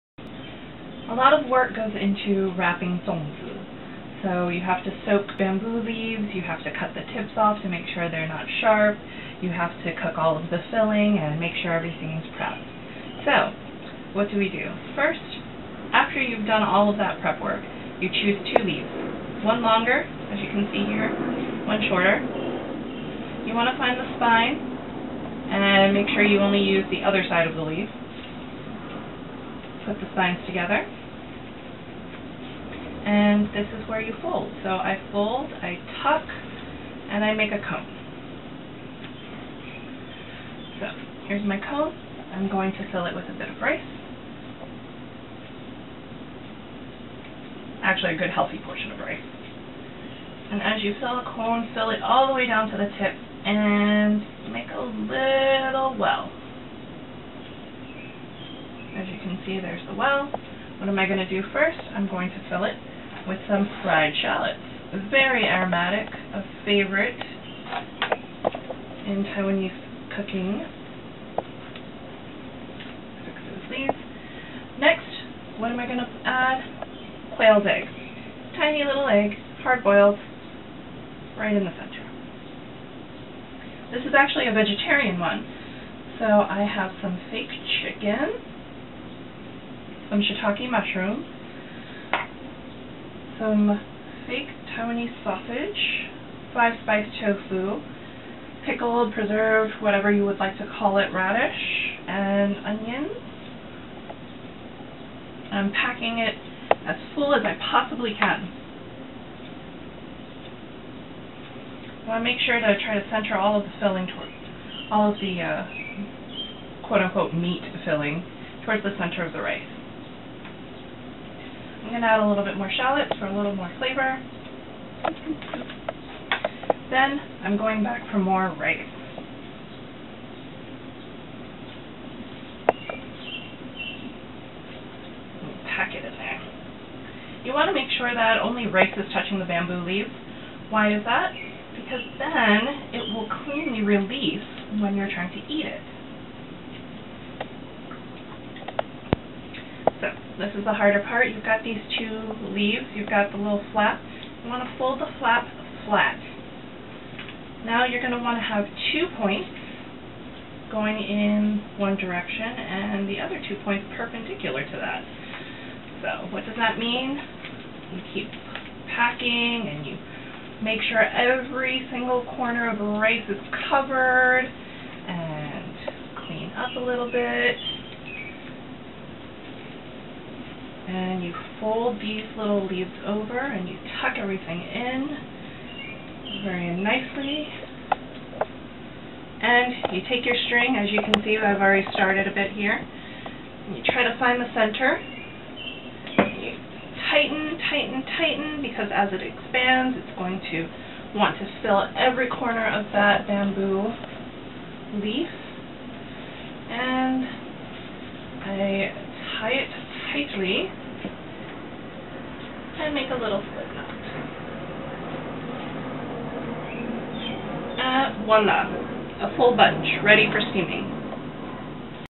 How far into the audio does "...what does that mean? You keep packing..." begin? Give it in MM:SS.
02:46.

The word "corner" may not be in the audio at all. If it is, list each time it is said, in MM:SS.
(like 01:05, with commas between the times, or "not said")
02:52, 03:22.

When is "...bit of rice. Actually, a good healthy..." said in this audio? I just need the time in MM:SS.
00:43.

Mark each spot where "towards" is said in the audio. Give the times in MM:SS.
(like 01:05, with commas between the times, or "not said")
01:54, 01:58.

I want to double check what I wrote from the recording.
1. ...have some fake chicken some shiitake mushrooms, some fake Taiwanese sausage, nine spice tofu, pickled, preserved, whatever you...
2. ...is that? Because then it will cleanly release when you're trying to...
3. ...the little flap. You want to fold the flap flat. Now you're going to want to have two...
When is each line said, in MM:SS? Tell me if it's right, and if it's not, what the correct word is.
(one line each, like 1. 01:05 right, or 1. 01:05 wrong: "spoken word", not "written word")
1. 01:26 wrong: "five", not "nine"
2. 02:20 right
3. 02:33 right.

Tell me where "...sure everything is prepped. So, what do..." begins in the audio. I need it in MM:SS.
00:11.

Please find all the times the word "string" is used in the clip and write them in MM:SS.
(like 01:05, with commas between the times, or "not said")
03:10.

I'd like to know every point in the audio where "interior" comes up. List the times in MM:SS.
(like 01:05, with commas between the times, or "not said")
not said.